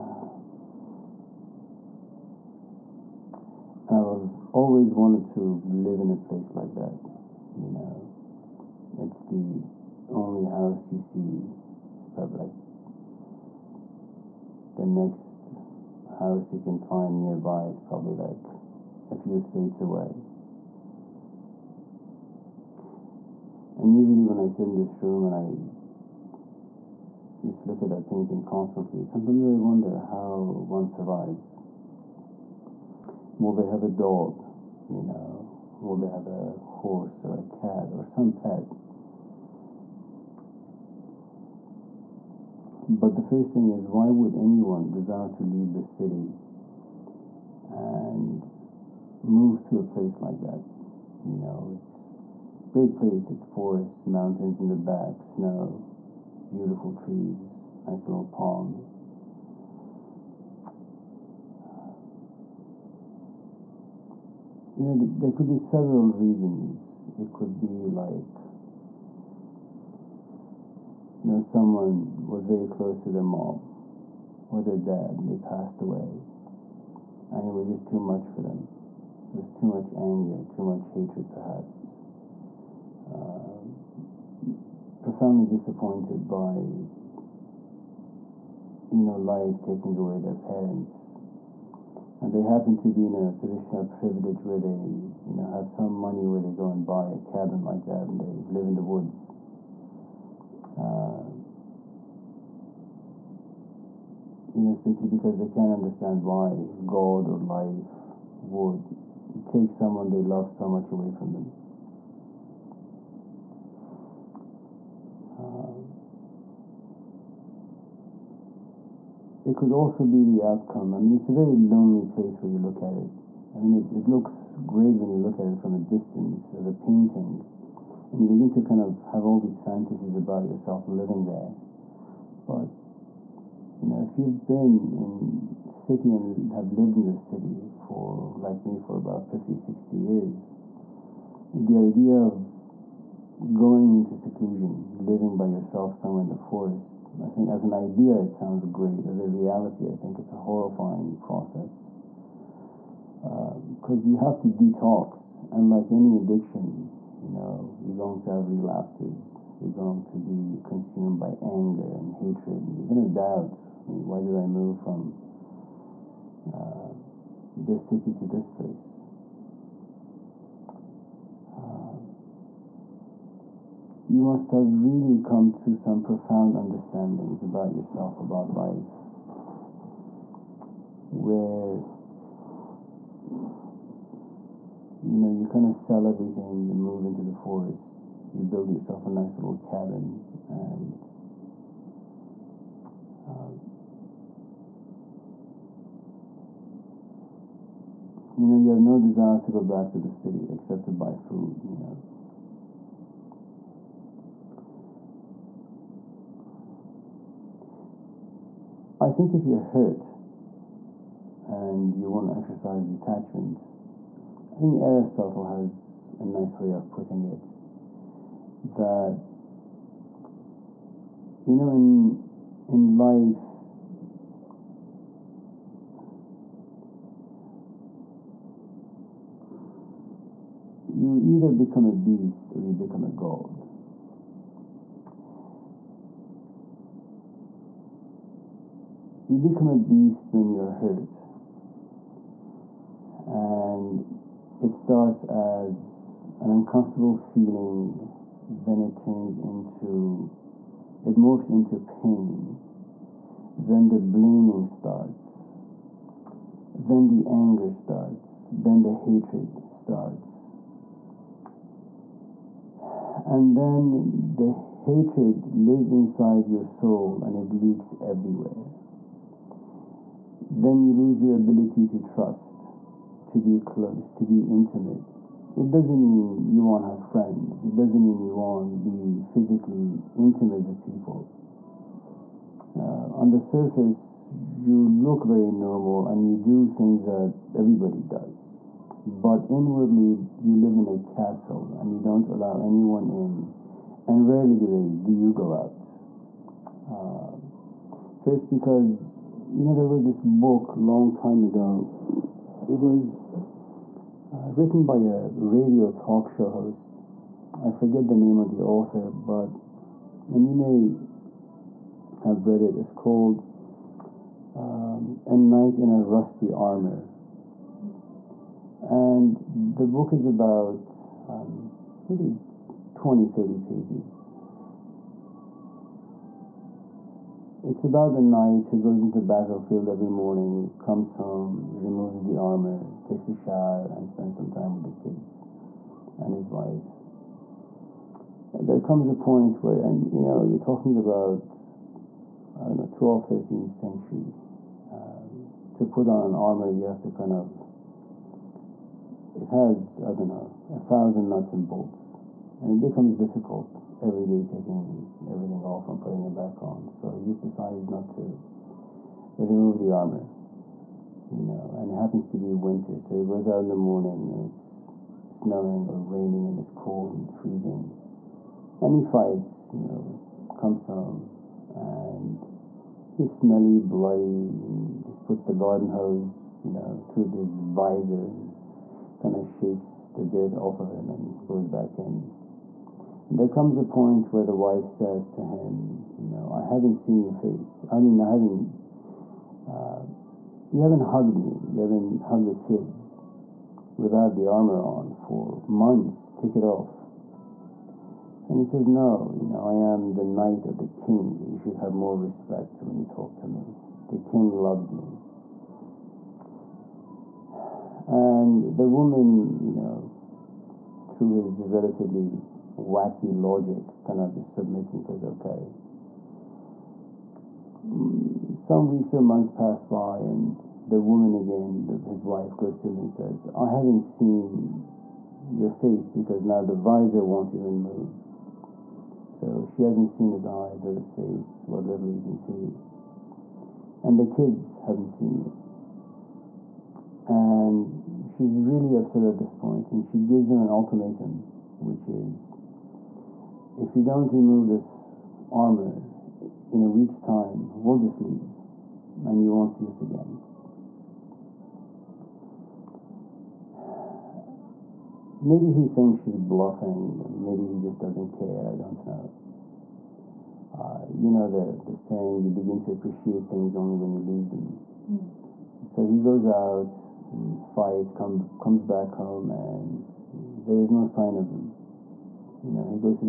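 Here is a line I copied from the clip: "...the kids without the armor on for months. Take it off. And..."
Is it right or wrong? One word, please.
right.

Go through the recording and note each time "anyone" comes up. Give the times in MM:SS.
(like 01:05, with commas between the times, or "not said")
00:44, 04:52.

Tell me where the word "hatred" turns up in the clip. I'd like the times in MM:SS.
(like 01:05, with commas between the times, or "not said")
01:20, 02:42, 04:18, 04:24.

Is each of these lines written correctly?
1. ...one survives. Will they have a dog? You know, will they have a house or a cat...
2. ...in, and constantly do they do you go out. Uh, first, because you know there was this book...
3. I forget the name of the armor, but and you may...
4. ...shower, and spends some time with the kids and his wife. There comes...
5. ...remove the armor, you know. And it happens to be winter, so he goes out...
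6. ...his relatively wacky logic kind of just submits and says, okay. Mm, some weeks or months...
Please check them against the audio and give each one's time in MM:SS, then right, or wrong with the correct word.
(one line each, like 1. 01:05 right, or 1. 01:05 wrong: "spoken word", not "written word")
1. 00:30 wrong: "horse", not "house"
2. 04:53 wrong: "rarely", not "constantly"
3. 05:07 wrong: "author", not "armor"
4. 05:33 right
5. 05:59 right
6. 06:51 right.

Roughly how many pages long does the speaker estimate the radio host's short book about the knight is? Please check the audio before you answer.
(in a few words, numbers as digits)
20 to 30 pages.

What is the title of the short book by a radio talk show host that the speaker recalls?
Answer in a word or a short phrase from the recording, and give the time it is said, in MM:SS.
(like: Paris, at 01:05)
A Knight in a Rusty Armor, at 05:15.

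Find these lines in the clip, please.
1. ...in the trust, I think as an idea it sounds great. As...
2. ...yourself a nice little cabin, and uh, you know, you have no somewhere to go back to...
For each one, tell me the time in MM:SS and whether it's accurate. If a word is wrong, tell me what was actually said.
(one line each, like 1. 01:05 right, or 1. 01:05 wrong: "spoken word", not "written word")
1. 02:26 wrong: "forest", not "trust"
2. 03:08 wrong: "desire", not "somewhere".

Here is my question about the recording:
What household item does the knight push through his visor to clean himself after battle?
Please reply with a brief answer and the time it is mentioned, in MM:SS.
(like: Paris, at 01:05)
garden hose, at 06:15.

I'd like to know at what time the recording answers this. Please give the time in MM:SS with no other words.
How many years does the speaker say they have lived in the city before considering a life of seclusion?
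02:18.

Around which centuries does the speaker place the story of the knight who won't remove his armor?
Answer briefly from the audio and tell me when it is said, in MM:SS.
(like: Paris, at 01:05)
12th or 13th century, at 05:42.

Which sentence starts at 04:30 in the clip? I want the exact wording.
Then you lose your ability to trust to be close, to be intimate.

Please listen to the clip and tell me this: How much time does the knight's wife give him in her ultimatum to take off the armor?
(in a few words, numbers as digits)
a week.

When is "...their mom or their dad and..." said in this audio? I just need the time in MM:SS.
01:13.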